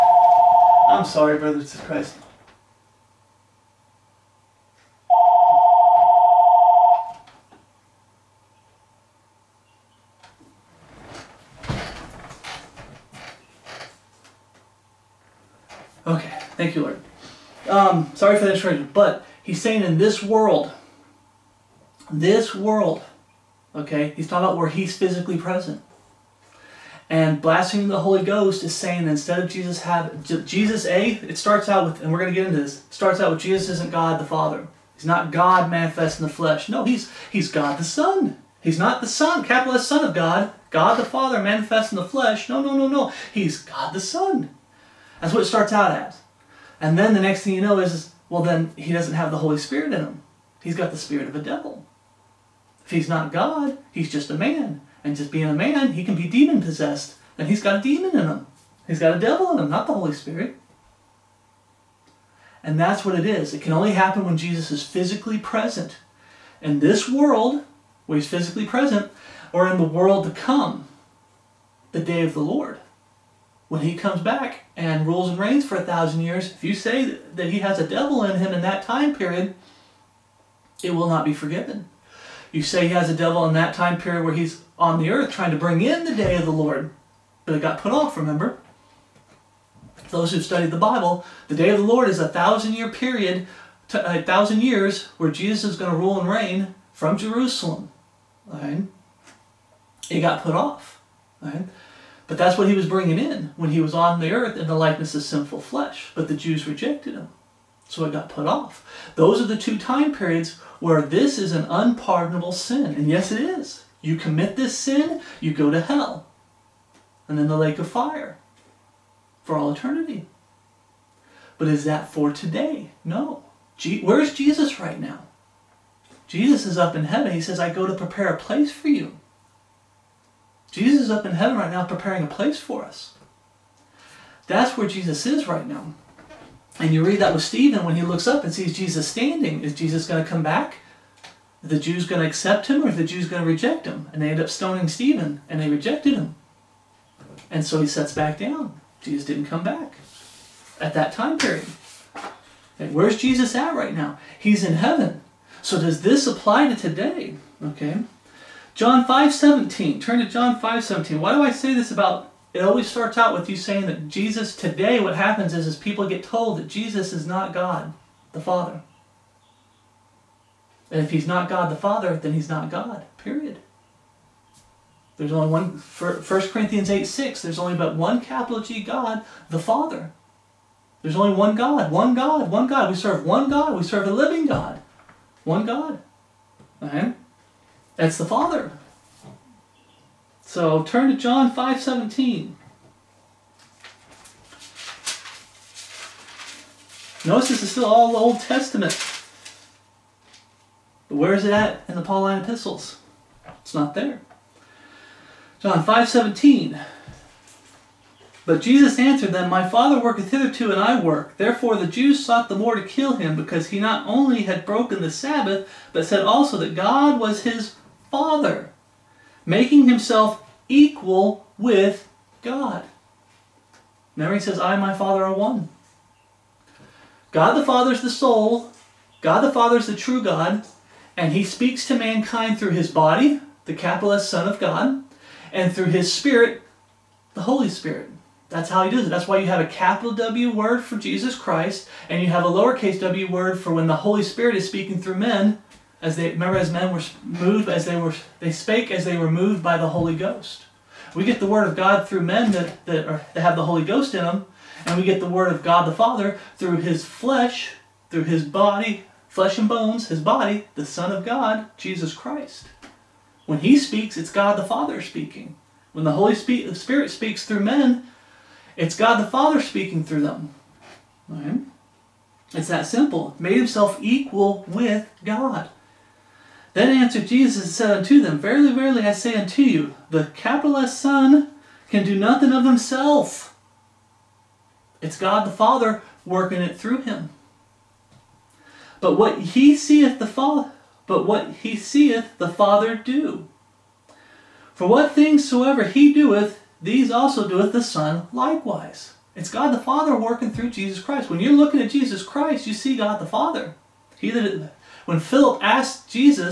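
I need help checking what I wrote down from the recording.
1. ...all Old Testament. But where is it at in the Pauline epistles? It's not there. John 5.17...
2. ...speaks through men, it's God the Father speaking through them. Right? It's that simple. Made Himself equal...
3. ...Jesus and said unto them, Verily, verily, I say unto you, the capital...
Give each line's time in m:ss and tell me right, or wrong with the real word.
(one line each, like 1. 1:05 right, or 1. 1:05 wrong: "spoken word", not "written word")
1. 3:17 right
2. 4:27 right
3. 4:37 right.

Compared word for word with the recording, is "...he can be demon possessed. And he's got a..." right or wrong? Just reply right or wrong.
right.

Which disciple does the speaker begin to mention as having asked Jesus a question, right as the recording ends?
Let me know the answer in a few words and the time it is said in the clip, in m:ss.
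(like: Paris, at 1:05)
Philip, at 5:05.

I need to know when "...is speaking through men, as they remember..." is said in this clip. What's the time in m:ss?
4:04.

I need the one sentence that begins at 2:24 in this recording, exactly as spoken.
And they end up stoning Stephen and they rejected him.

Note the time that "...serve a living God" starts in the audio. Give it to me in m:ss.
3:03.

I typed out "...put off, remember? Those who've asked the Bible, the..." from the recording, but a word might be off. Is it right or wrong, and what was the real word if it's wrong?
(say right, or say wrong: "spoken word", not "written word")
wrong: "studied", not "asked".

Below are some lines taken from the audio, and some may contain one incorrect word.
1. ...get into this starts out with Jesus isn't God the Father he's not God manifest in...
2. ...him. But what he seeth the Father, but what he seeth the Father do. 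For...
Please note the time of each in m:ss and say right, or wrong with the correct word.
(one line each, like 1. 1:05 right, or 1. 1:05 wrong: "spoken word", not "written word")
1. 0:32 right
2. 4:47 right.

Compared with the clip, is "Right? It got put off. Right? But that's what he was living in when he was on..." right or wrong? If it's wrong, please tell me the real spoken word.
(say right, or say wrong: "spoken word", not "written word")
wrong: "bringing", not "living".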